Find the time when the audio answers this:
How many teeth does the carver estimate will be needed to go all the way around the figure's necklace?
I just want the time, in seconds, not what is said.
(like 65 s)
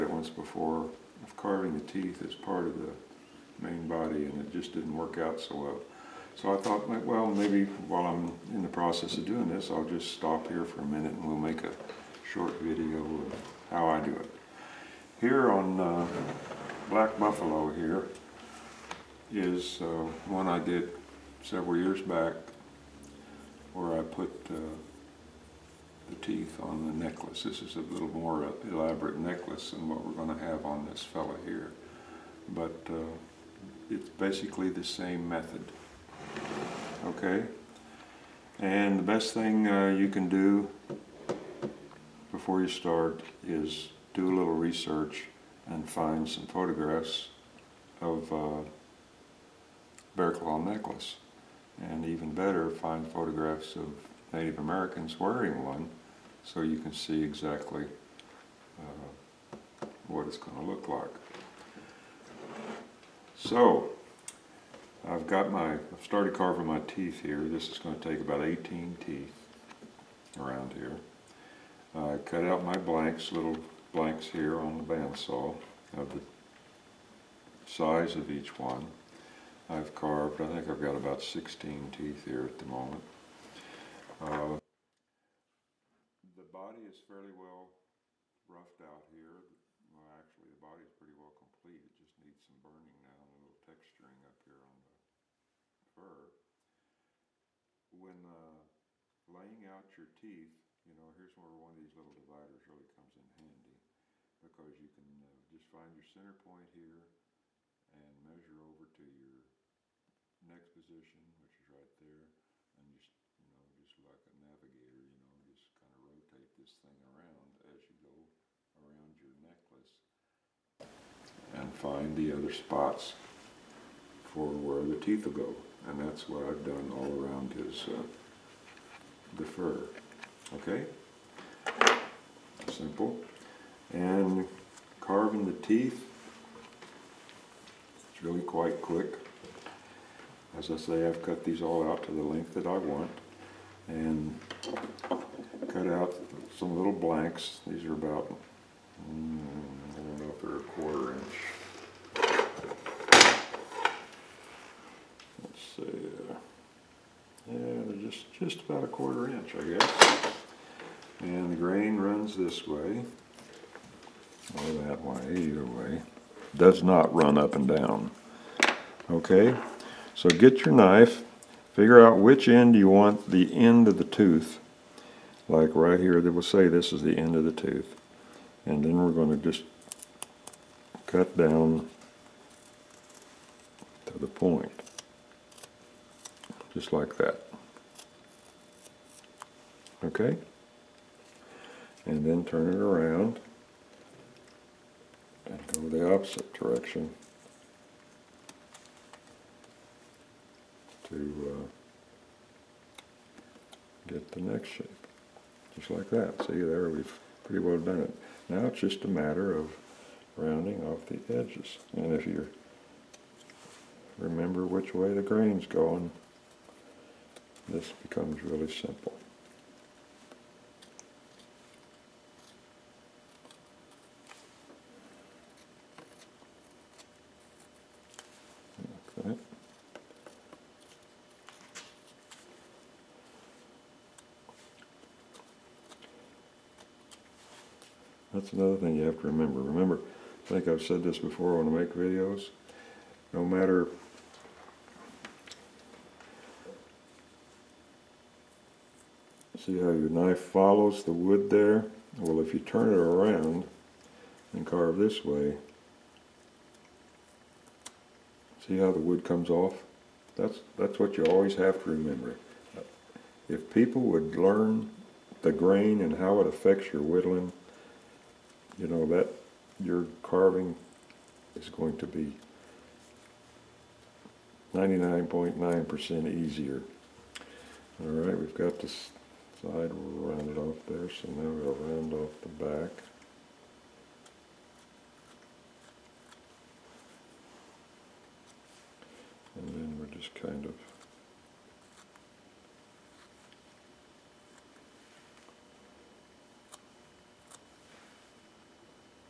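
68 s.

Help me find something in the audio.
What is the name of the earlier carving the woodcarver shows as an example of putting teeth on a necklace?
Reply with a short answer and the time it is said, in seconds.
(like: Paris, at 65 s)
Black Buffalo, at 16 s.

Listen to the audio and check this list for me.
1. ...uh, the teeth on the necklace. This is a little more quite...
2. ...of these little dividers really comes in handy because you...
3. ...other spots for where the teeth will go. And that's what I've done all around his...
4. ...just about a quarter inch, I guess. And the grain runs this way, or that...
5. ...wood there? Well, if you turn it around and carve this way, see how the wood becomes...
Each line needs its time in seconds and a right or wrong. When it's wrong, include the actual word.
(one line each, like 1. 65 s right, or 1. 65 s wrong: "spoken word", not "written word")
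1. 24 s wrong: "elaborate", not "quite"
2. 101 s right
3. 122 s right
4. 158 s right
5. 251 s wrong: "comes", not "becomes".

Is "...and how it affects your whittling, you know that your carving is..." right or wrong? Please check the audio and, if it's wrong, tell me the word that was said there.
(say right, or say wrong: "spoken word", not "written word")
right.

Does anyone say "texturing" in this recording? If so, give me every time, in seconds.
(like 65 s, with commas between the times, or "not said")
93 s.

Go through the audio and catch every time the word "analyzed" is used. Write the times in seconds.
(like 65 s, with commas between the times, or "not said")
not said.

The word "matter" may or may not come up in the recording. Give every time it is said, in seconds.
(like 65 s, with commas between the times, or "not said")
209 s, 243 s.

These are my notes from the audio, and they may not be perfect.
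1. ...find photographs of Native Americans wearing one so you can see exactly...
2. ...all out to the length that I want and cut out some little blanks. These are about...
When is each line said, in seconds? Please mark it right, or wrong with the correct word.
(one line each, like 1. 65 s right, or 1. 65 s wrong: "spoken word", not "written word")
1. 52 s right
2. 141 s right.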